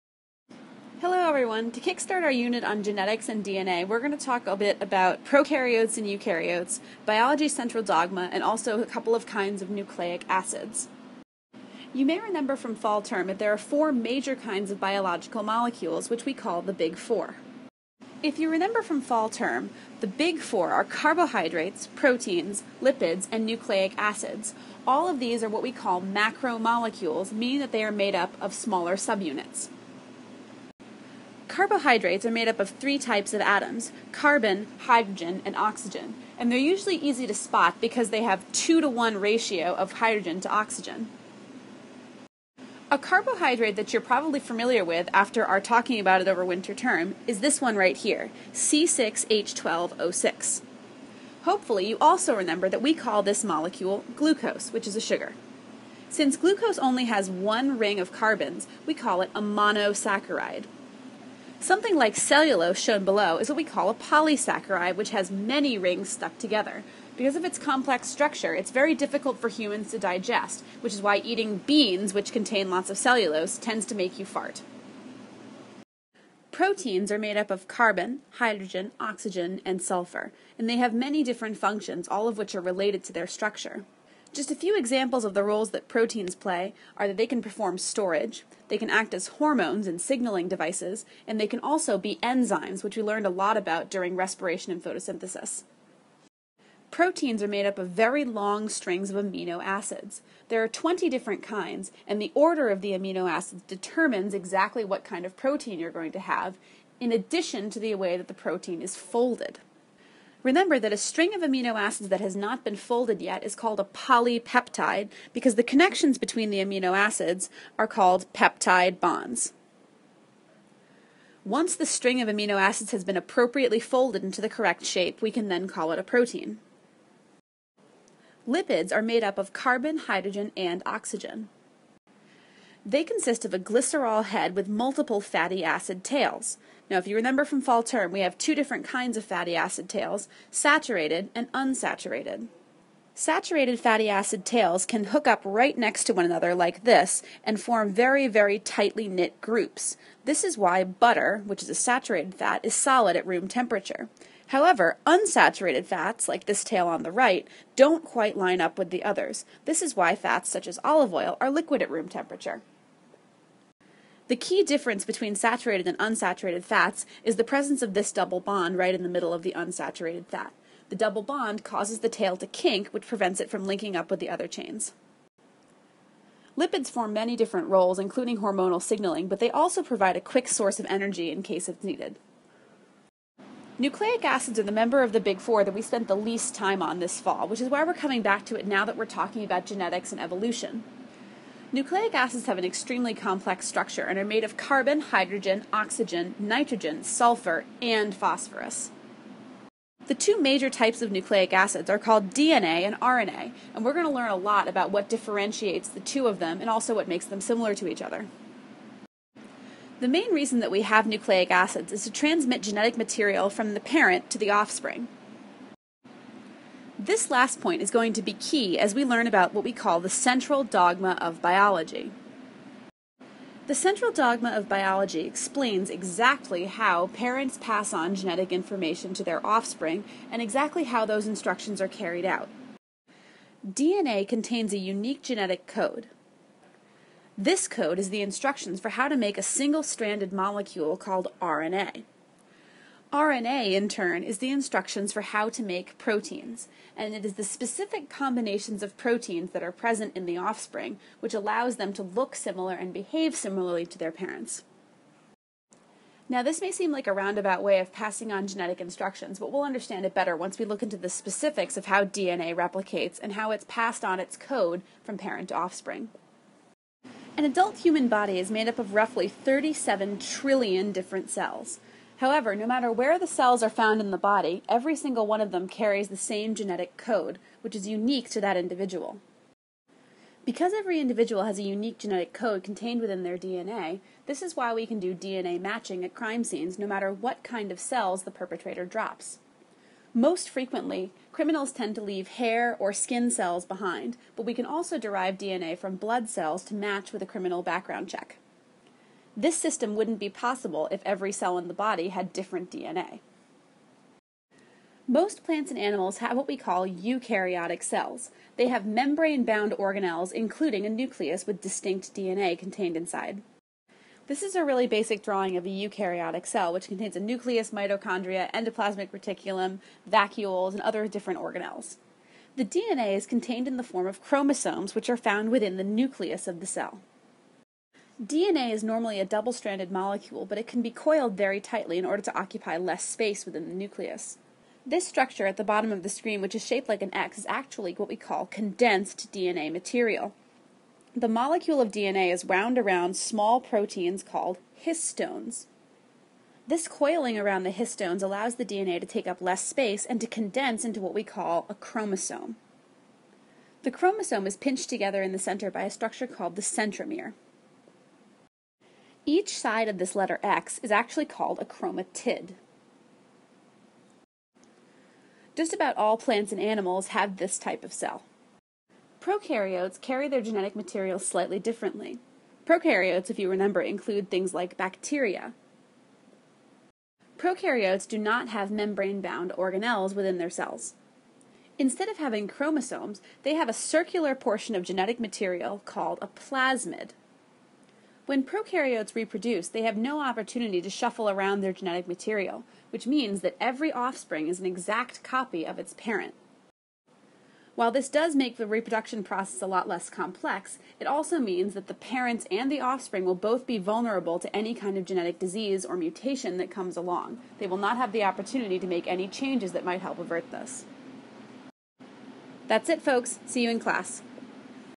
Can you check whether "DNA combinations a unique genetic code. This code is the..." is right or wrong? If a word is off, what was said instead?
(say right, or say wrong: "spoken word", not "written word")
wrong: "contains", not "combinations".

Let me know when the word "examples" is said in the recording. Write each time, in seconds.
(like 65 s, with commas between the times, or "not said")
84 s.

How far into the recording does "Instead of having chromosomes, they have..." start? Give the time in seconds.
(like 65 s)
381 s.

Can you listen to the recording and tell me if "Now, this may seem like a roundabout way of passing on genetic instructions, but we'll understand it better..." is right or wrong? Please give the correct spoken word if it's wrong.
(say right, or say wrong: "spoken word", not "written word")
right.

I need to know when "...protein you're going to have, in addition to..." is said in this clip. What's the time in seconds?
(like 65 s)
105 s.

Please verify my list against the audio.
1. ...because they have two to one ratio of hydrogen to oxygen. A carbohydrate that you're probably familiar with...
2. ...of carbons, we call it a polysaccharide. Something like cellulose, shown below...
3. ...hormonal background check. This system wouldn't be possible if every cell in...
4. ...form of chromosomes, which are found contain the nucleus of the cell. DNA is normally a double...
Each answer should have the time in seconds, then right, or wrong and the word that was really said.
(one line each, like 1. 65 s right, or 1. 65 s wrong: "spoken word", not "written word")
1. 37 s right
2. 57 s wrong: "monosaccharide", not "polysaccharide"
3. 297 s wrong: "criminal", not "hormonal"
4. 323 s wrong: "within", not "contain".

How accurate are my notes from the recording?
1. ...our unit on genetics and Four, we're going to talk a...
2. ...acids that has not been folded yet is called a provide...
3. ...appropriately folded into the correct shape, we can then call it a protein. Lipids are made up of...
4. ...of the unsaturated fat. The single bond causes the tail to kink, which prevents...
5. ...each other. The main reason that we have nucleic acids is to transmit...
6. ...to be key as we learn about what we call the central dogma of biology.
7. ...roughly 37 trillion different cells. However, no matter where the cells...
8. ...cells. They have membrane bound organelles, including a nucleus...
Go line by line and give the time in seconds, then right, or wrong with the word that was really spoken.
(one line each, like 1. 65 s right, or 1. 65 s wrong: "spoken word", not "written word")
1. 2 s wrong: "DNA", not "Four"
2. 111 s wrong: "polypeptide", not "provide"
3. 123 s right
4. 169 s wrong: "double", not "single"
5. 207 s right
6. 218 s right
7. 268 s right
8. 307 s right.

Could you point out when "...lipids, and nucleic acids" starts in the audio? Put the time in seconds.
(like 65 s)
22 s.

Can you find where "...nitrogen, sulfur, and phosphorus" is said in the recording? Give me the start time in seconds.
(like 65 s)
196 s.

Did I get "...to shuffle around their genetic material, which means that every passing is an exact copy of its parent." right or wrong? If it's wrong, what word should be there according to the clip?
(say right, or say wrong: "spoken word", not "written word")
wrong: "offspring", not "passing".